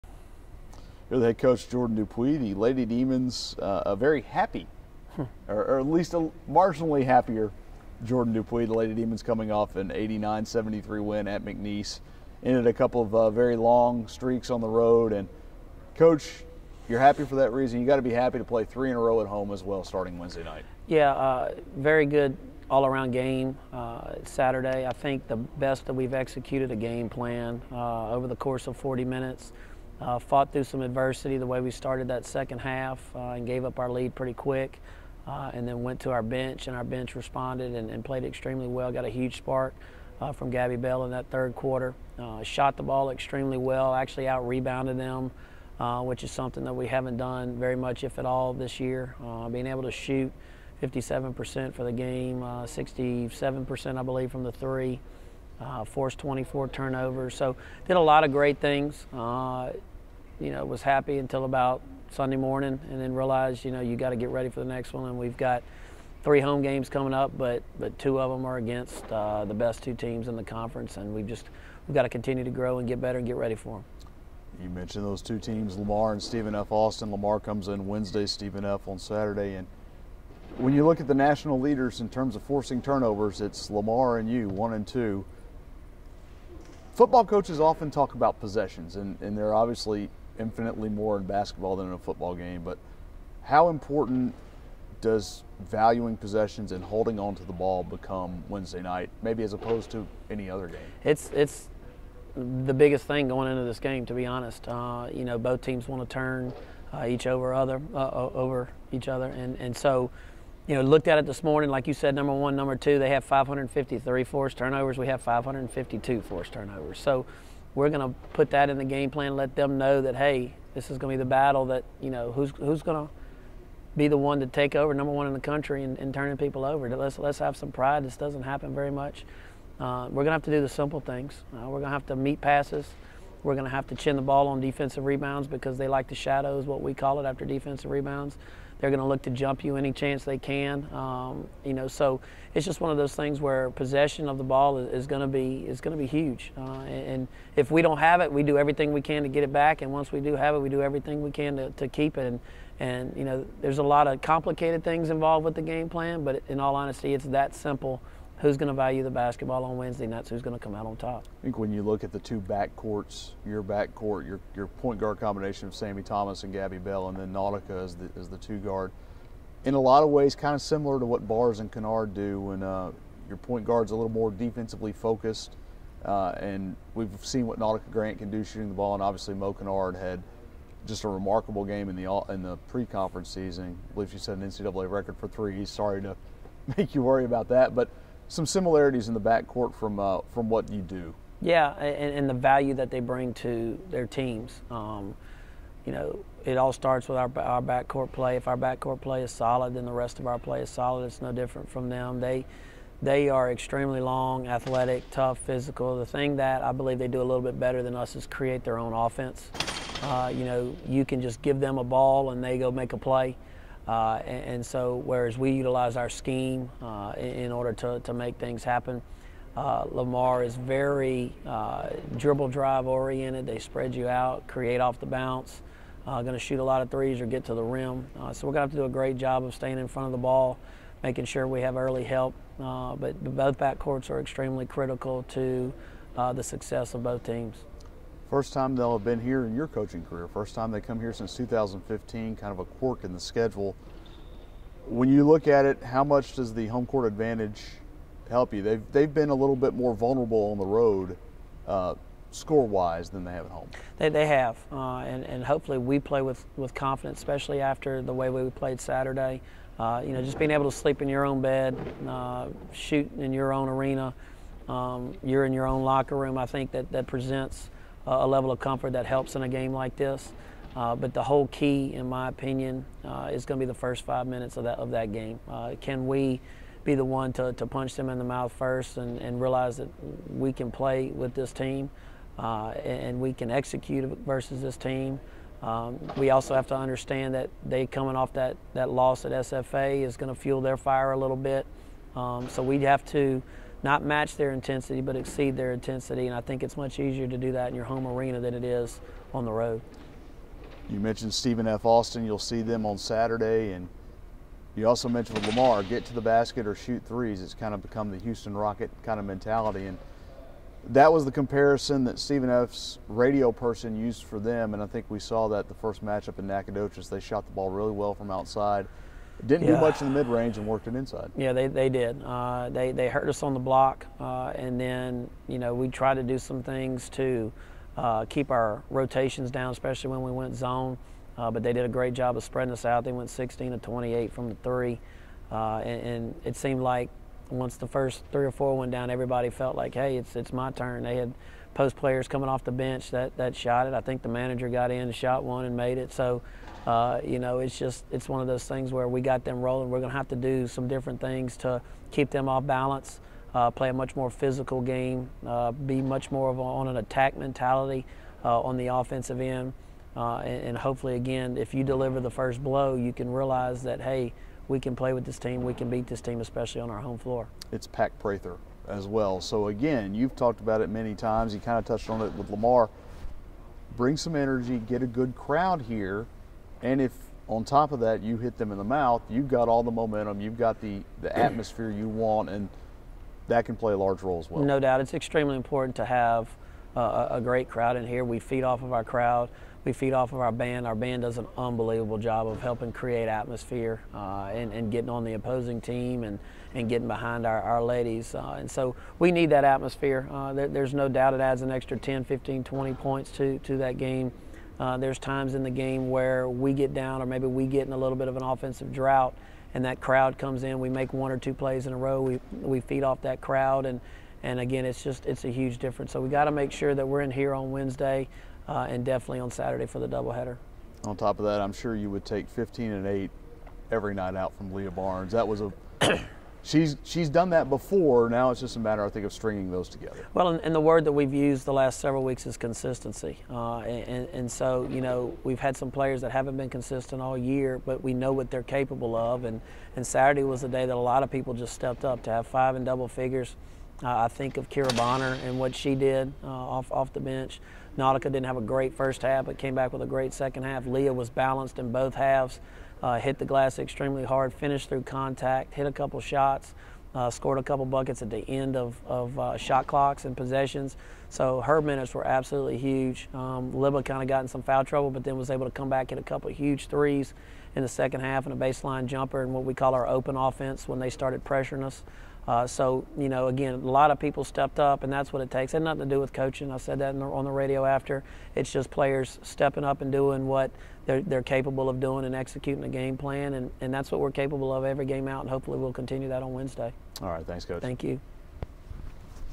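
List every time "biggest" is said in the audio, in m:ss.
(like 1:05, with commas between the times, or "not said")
1:42.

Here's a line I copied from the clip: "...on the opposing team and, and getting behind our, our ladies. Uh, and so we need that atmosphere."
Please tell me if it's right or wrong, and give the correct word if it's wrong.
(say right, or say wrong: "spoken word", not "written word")
right.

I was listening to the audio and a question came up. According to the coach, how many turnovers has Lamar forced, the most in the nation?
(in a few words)
553.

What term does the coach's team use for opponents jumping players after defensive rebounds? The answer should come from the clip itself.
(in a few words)
shadows.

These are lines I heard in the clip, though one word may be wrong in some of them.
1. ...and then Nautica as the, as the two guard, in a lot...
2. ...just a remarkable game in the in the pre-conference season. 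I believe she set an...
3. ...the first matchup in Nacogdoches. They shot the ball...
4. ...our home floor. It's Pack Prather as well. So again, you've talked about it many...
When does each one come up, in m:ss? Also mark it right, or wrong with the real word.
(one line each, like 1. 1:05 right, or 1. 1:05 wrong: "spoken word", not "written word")
1. 2:47 right
2. 3:00 right
3. 5:15 right
4. 6:06 right.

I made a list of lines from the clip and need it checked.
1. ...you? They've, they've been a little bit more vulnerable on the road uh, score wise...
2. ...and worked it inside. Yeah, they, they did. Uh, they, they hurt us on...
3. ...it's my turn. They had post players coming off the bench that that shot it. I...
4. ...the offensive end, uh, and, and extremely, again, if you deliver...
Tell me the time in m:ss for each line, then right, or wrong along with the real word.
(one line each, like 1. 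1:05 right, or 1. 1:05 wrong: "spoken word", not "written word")
1. 4:08 right
2. 5:20 right
3. 5:40 right
4. 5:58 wrong: "hopefully", not "extremely".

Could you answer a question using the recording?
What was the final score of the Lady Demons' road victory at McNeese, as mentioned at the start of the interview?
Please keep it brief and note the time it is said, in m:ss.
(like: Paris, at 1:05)
89-73, at 0:09.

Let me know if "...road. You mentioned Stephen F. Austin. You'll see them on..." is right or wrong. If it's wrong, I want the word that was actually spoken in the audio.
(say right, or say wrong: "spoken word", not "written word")
right.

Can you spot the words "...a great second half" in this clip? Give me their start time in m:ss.
7:30.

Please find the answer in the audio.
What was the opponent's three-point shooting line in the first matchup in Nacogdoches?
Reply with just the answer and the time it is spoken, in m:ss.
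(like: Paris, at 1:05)
16 of 28, at 5:33.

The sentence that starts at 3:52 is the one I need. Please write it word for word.
but both backcourts are extremely critical to the success of both teams.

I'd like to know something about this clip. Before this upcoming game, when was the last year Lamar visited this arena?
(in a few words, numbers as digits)
2015.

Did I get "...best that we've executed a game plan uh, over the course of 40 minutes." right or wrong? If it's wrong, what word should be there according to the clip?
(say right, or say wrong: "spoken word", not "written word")
right.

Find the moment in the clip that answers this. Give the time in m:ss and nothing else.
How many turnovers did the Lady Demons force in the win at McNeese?
0:56.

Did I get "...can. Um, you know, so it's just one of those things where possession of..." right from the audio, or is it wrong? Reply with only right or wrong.
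right.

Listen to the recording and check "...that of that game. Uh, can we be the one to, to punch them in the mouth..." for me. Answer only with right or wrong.
right.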